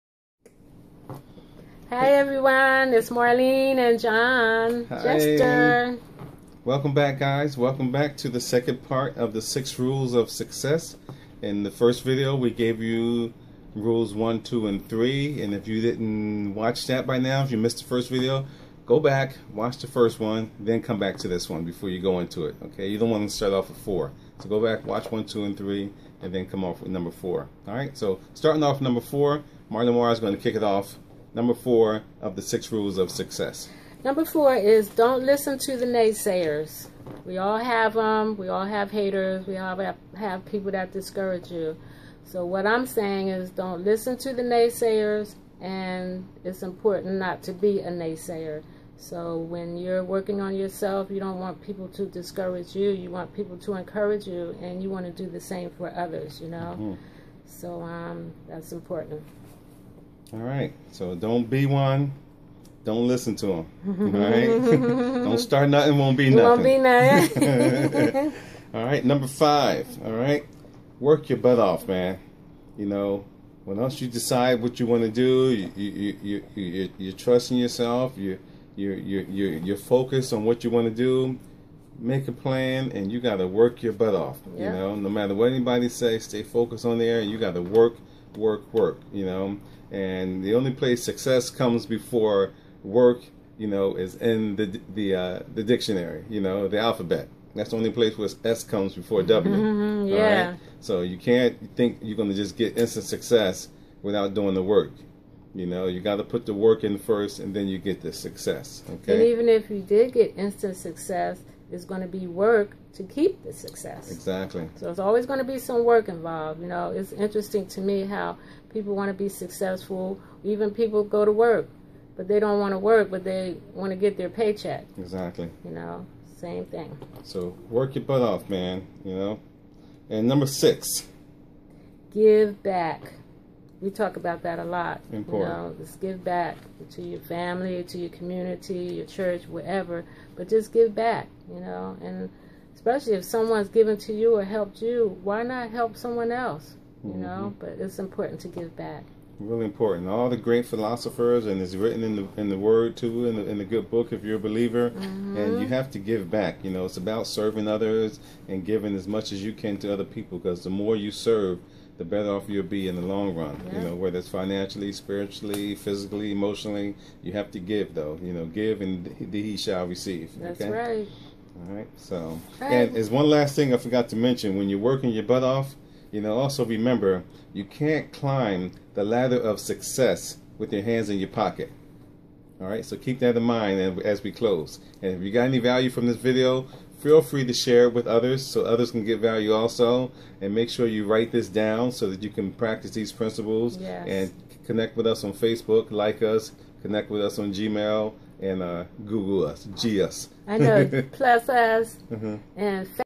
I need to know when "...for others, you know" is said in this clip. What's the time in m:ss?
0:55.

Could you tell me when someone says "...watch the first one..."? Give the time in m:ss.
0:19.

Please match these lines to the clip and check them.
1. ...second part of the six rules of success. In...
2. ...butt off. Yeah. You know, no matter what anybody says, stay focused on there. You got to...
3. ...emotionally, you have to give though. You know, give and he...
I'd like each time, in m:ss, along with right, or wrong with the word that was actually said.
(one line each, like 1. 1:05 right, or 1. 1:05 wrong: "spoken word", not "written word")
1. 0:08 right
2. 1:23 right
3. 2:46 right.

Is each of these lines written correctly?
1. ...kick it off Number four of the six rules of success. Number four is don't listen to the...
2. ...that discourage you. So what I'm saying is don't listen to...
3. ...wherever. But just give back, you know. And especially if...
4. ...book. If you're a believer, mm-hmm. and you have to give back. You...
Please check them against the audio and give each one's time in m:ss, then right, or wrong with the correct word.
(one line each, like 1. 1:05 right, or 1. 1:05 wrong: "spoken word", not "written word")
1. 0:30 right
2. 0:40 right
3. 2:19 right
4. 2:33 right.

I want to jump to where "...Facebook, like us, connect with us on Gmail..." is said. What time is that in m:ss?
3:15.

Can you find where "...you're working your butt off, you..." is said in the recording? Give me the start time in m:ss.
2:54.